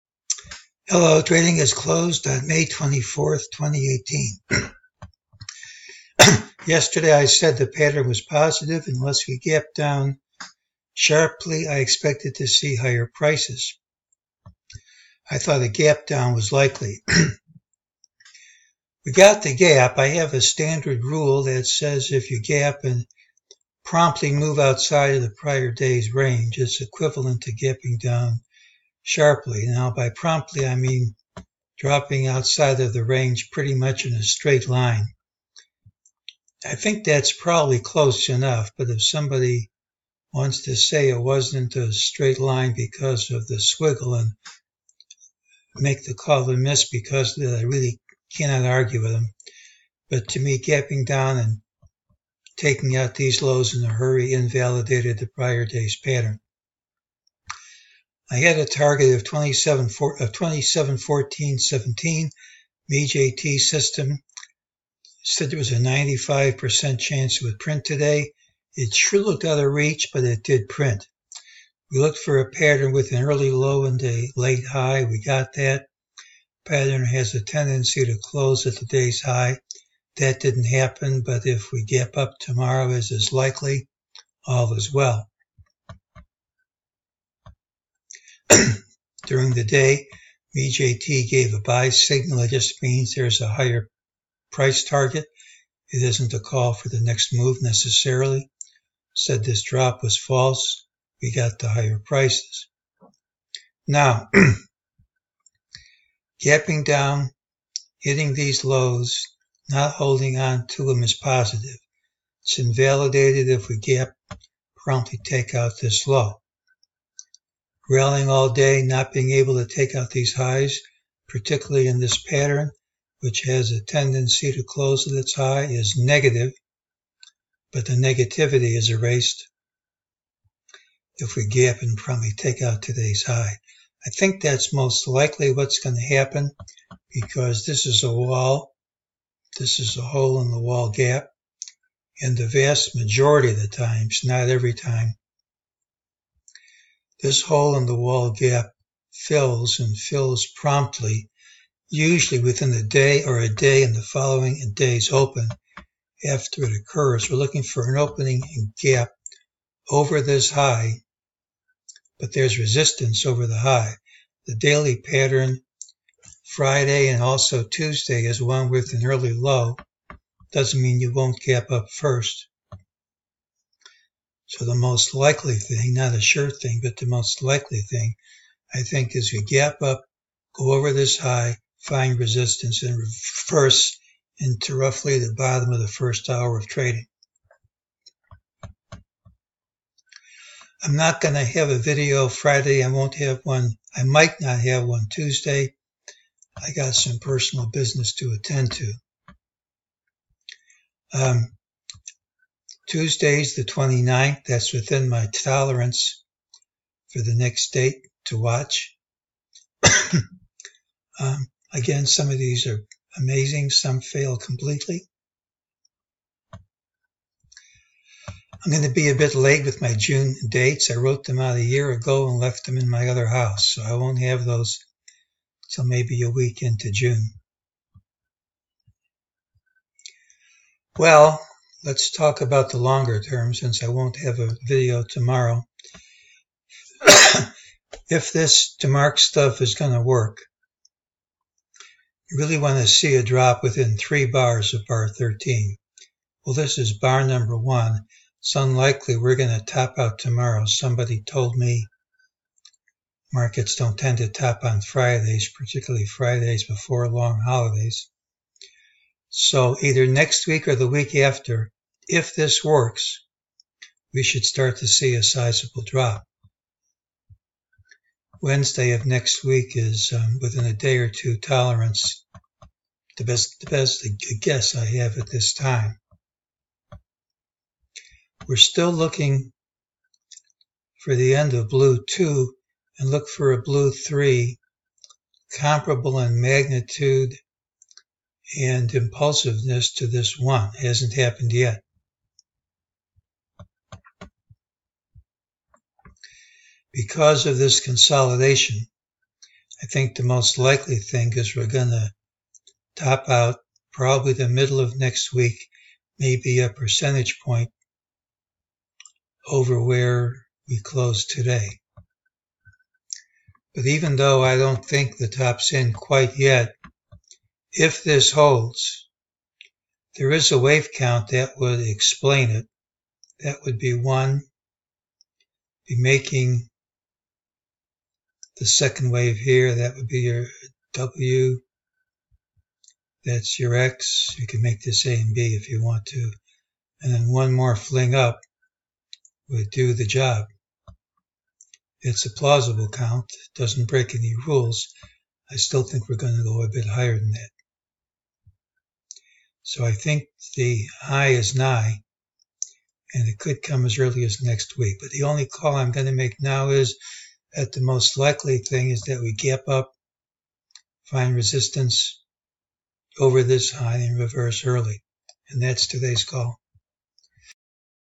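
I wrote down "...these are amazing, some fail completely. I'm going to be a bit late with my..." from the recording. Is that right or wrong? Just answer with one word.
right.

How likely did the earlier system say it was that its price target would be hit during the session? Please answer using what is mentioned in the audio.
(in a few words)
95%.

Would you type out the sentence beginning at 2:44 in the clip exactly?
The daily pattern Friday and also Tuesday is one with an early low.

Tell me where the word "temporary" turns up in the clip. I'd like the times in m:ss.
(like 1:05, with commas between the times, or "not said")
not said.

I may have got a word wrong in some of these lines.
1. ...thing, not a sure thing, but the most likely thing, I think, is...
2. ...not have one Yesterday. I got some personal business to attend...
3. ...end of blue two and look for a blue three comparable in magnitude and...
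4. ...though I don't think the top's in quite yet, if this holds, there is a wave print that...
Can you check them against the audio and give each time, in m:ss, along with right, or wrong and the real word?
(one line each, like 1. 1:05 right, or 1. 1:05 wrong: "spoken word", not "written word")
1. 2:55 right
2. 3:14 wrong: "Tuesday", not "Yesterday"
3. 4:41 right
4. 5:14 wrong: "count", not "print".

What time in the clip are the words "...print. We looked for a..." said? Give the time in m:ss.
1:10.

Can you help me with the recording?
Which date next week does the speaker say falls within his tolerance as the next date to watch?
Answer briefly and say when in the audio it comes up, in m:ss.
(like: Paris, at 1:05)
29th, at 3:23.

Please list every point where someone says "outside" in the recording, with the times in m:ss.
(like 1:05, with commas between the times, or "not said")
0:24, 0:32.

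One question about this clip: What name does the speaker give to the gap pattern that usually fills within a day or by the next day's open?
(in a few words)
hole-in-the-wall gap.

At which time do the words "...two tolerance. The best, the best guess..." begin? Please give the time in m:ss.
4:31.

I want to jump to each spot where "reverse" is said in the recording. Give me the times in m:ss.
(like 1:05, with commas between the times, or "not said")
3:02, 6:04.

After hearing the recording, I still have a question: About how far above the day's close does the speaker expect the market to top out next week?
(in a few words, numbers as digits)
1 percentage point.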